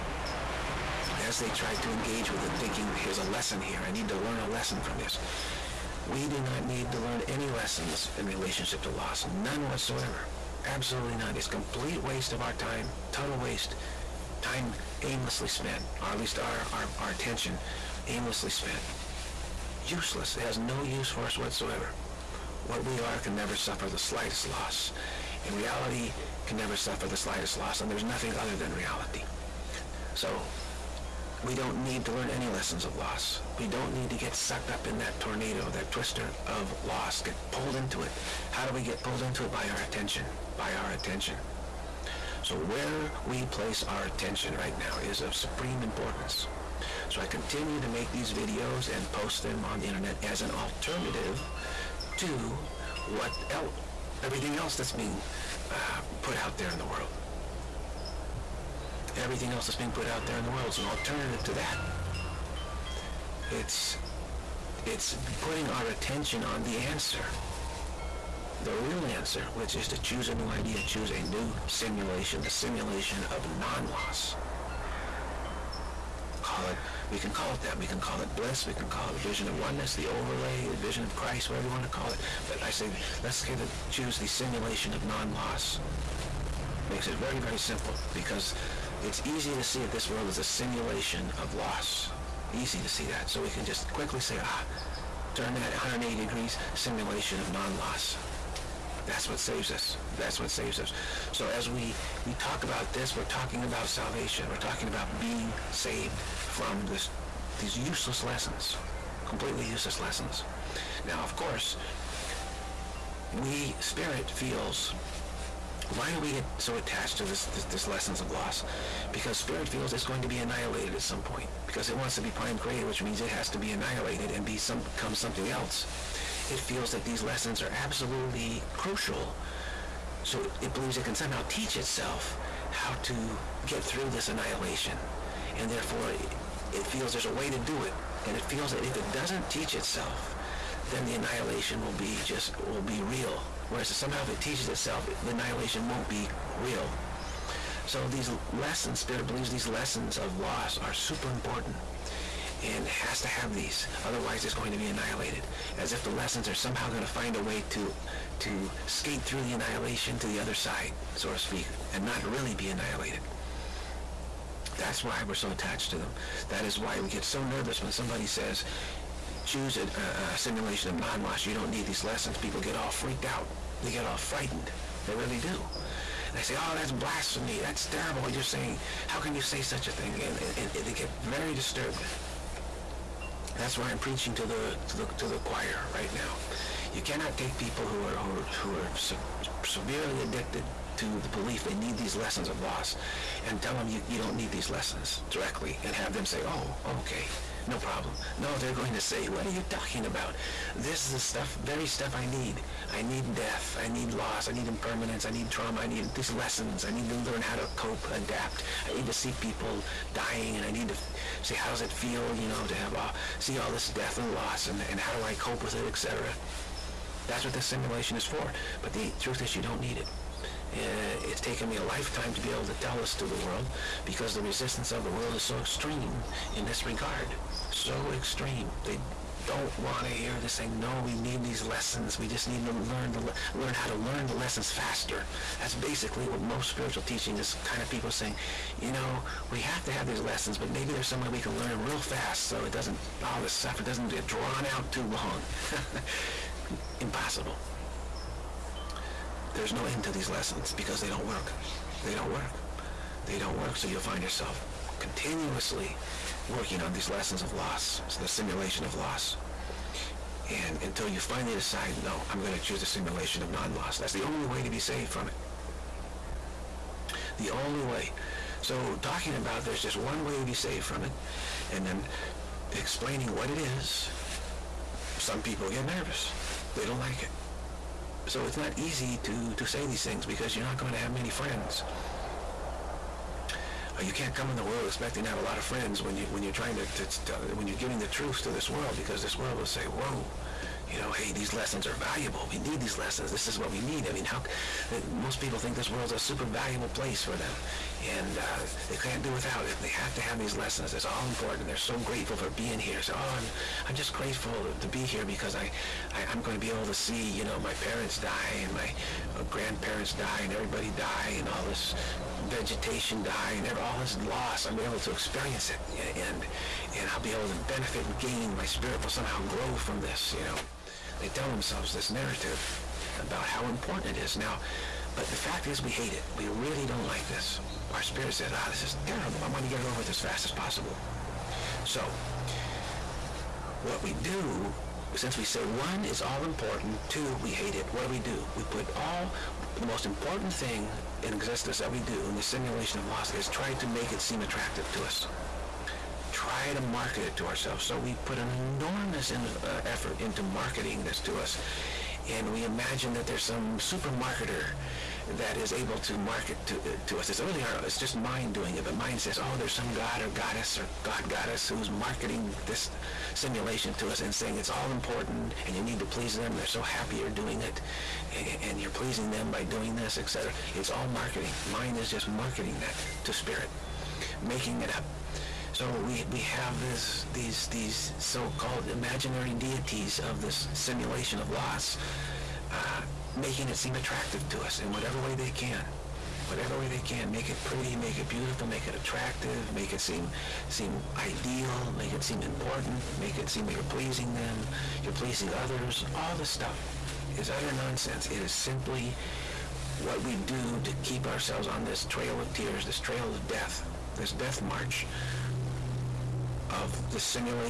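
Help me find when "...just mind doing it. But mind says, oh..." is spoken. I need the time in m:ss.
5:57.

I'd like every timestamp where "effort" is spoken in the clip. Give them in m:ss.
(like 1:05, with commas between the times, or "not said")
5:49.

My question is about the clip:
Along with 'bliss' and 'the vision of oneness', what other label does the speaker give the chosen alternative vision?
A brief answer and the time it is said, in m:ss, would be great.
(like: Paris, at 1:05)
the overlay, at 1:19.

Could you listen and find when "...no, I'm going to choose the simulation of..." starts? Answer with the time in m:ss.
4:22.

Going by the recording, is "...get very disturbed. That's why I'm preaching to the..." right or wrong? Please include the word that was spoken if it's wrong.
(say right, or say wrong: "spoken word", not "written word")
right.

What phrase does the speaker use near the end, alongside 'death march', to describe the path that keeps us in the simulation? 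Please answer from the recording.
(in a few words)
trail of tears.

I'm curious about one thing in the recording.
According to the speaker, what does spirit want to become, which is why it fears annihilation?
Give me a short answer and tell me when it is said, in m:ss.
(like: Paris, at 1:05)
prime creator, at 2:02.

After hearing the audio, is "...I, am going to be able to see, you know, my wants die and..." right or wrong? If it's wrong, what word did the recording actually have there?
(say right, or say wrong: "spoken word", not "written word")
wrong: "parents", not "wants".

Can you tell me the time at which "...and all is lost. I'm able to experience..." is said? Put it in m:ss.
5:13.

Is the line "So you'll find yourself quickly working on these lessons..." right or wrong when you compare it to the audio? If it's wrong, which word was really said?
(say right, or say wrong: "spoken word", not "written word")
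wrong: "continuously", not "quickly".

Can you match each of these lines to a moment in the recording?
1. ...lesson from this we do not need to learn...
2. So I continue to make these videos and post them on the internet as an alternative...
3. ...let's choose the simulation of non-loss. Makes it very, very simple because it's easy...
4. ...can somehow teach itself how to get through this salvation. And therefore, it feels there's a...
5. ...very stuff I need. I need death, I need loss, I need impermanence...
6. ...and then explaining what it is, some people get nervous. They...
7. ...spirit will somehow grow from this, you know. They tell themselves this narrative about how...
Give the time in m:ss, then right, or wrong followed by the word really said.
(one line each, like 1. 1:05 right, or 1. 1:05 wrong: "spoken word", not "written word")
1. 0:04 right
2. 0:47 right
3. 1:23 right
4. 2:11 wrong: "annihilation", not "salvation"
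5. 3:21 right
6. 4:31 right
7. 5:18 right.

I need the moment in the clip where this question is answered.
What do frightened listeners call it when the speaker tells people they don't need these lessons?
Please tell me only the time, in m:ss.
2:56.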